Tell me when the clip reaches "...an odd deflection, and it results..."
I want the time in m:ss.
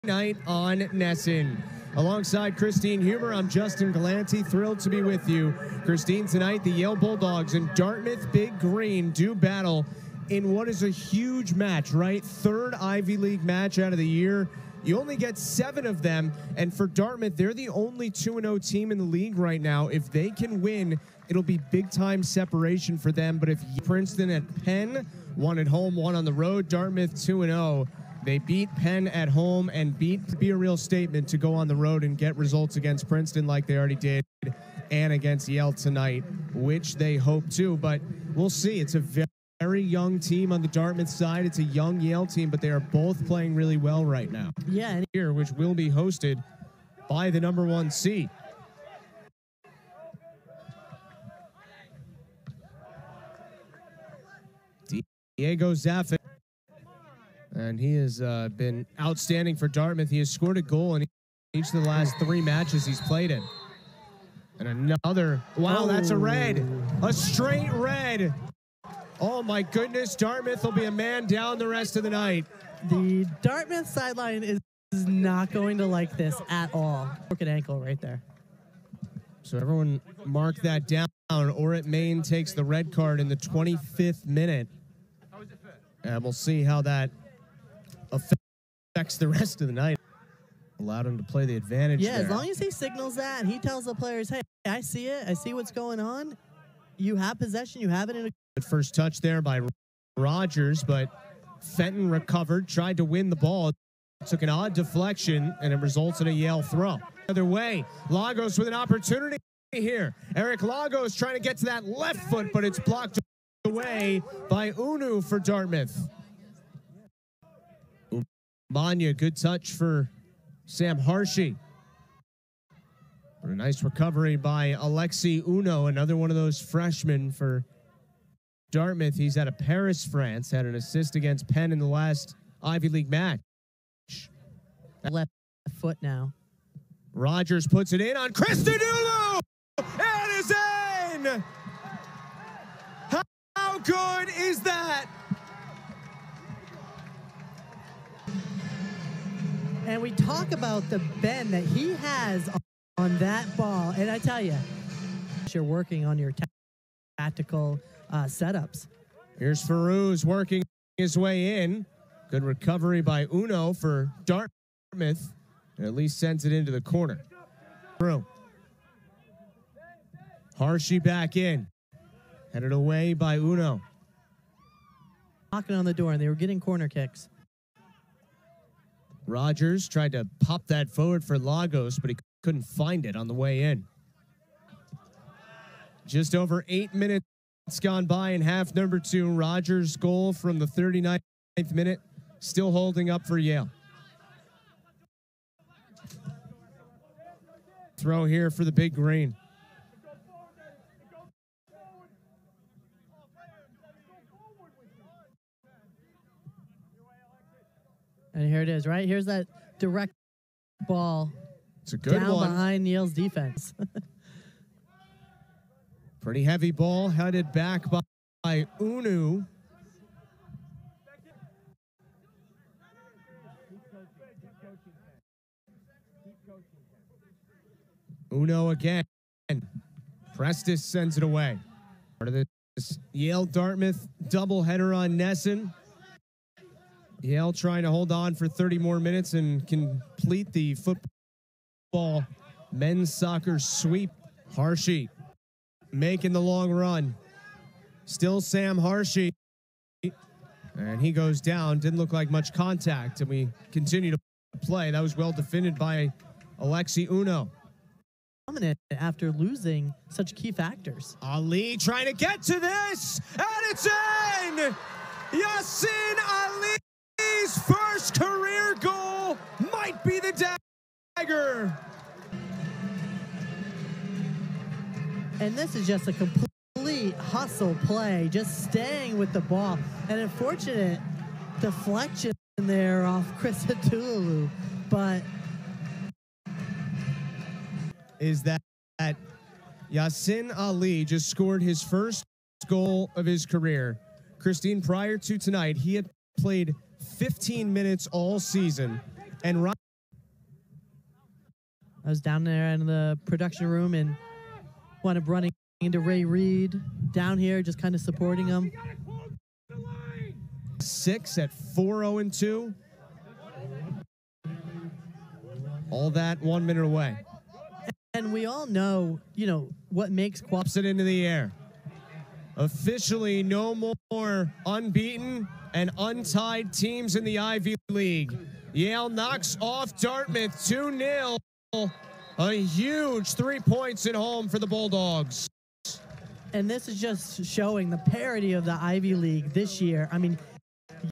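1:44.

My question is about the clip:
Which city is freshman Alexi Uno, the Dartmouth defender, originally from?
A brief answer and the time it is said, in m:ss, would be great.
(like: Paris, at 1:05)
Paris, France, at 2:09.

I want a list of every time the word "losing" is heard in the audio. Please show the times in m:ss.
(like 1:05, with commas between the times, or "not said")
4:19.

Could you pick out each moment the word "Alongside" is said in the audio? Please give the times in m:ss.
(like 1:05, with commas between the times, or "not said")
0:01.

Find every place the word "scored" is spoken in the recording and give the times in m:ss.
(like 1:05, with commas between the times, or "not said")
1:00, 4:51.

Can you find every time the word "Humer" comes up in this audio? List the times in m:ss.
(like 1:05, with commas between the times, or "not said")
0:03.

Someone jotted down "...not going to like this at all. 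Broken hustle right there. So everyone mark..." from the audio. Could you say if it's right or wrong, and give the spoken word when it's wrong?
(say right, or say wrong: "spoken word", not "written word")
wrong: "ankle", not "hustle".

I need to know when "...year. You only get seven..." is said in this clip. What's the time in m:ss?
0:14.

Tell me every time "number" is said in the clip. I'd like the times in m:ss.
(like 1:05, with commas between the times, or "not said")
0:47, 3:08.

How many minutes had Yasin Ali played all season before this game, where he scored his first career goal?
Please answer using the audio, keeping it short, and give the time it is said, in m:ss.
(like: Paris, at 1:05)
15, at 4:57.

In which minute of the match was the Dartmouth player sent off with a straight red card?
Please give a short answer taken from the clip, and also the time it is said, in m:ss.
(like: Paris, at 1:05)
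25th, at 1:23.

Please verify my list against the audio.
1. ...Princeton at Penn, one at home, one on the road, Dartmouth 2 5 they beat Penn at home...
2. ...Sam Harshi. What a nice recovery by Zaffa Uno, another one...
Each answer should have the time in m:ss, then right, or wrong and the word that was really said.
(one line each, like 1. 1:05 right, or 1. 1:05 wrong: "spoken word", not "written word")
1. 0:23 wrong: "0", not "5"
2. 2:00 wrong: "Alexi", not "Zaffa".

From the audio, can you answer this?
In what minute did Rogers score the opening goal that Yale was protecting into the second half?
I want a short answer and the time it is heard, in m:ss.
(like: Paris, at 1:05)
39th, at 3:10.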